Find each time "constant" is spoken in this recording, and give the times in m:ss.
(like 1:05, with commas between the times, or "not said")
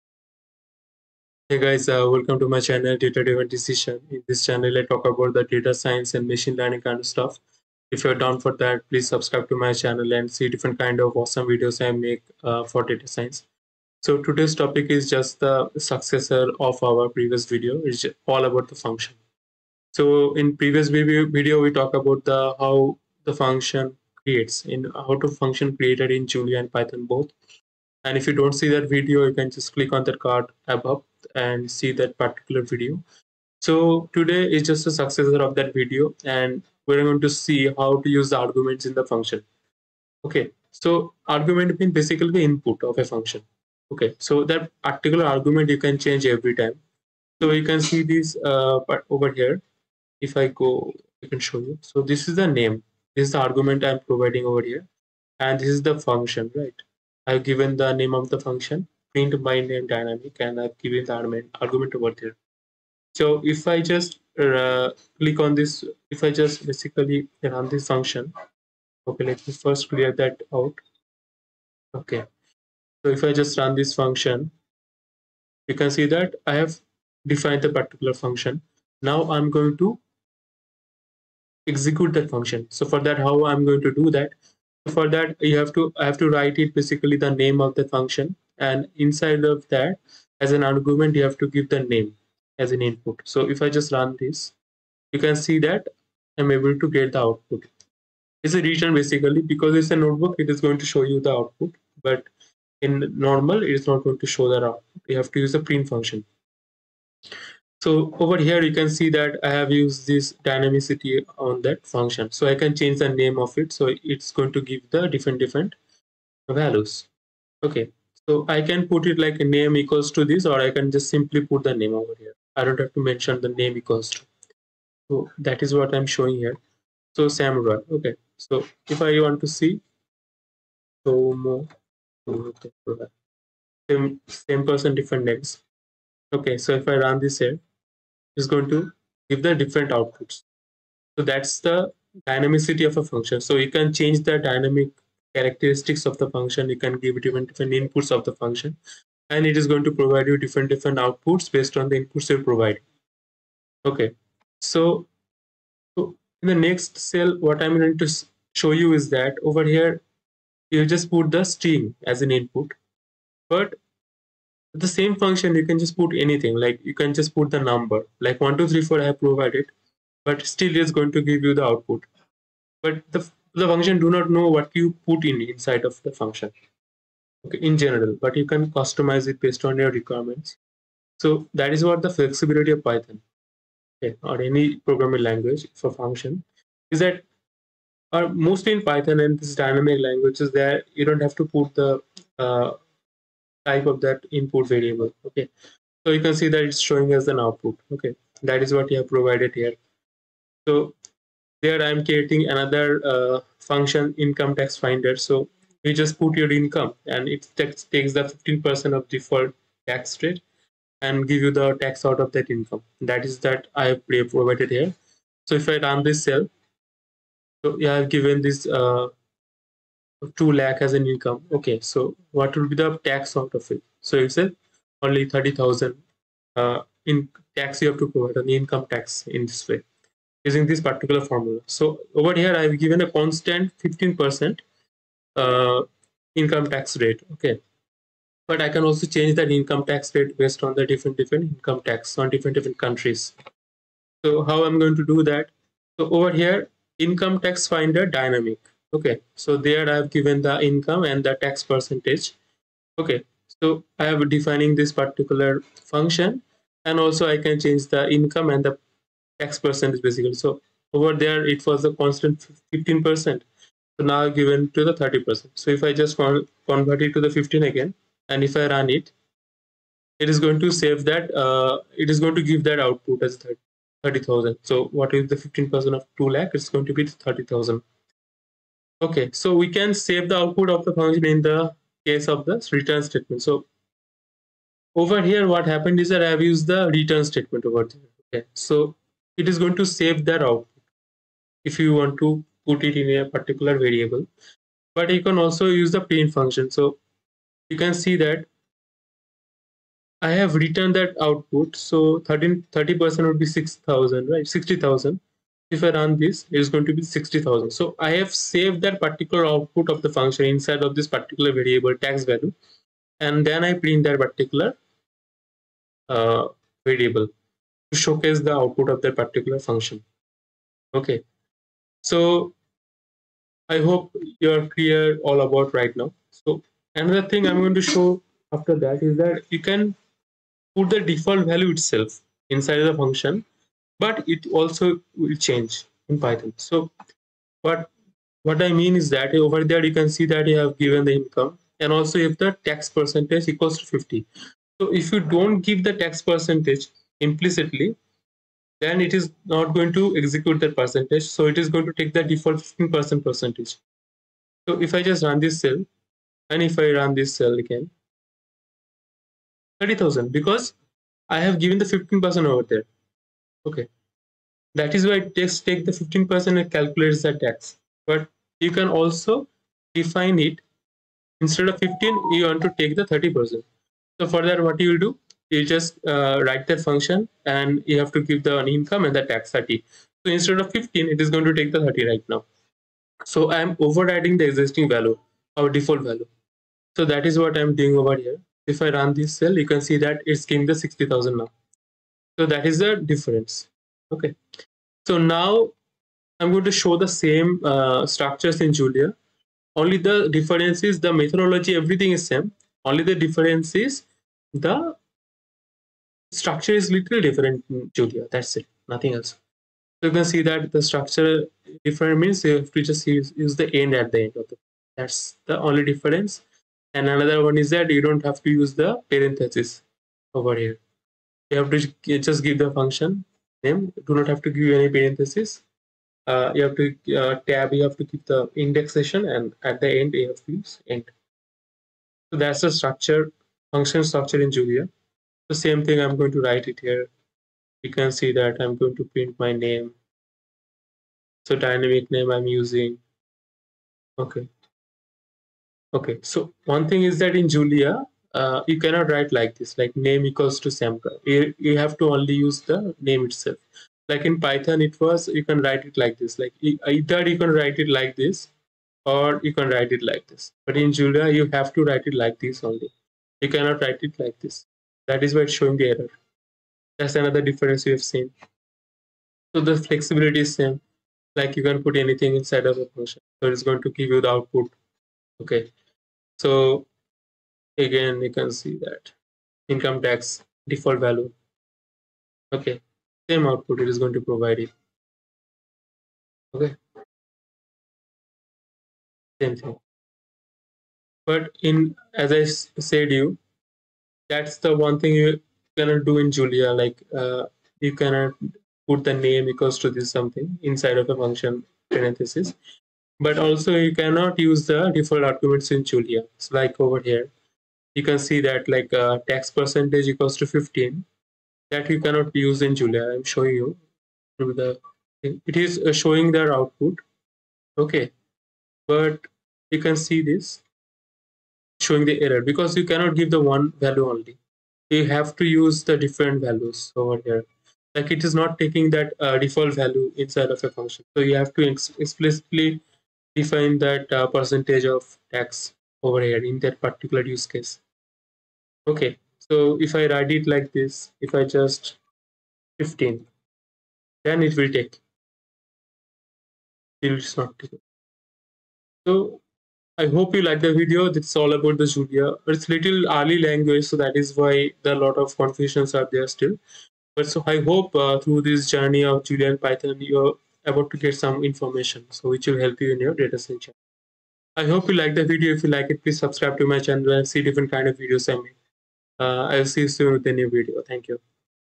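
3:53, 4:21.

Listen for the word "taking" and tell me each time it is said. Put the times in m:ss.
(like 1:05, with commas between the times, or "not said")
8:48.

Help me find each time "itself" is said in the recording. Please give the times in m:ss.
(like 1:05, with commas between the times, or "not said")
5:31, 7:33.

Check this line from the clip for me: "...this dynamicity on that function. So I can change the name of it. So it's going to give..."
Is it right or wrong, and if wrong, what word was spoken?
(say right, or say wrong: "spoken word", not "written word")
right.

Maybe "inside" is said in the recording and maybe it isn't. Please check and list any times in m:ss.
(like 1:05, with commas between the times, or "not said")
1:28, 2:55, 5:10, 5:32, 7:52, 8:20, 8:50.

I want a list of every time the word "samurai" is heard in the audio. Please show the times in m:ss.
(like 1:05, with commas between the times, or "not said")
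2:07.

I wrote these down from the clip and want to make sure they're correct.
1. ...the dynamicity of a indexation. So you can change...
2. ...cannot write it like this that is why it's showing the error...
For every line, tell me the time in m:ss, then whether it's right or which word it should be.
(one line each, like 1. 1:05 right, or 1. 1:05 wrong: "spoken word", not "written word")
1. 2:21 wrong: "function", not "indexation"
2. 7:43 right.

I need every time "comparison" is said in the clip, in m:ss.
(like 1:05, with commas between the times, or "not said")
not said.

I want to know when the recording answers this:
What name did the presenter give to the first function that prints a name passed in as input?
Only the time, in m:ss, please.
0:59.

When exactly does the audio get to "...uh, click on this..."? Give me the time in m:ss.
1:04.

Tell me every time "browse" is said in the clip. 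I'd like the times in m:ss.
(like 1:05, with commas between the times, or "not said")
not said.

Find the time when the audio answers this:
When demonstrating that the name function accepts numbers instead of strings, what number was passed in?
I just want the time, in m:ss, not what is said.
2:48.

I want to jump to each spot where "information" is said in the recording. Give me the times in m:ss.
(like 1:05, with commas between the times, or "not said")
9:21.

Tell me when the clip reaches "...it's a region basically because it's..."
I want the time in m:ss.
1:38.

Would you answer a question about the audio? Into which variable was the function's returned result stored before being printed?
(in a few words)
tax value.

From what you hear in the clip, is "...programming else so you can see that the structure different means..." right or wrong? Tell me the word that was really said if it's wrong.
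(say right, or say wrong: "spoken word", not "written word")
wrong: "nothing", not "programming".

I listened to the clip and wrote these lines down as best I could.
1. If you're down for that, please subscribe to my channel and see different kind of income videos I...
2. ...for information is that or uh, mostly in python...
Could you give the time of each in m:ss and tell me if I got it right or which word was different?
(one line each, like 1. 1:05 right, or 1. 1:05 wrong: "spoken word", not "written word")
1. 0:07 wrong: "awesome", not "income"
2. 3:05 wrong: "function", not "information".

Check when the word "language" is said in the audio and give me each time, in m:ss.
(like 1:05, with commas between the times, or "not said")
3:05, 3:10, 9:13.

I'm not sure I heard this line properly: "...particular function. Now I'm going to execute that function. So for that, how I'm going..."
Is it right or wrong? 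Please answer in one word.
right.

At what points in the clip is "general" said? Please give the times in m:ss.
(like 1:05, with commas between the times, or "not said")
2:57.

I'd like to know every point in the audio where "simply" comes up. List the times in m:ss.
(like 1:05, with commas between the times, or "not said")
2:01.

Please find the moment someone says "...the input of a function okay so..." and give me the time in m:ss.
0:42.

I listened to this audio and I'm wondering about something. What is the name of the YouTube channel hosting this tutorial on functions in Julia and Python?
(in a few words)
Data Driven Decision.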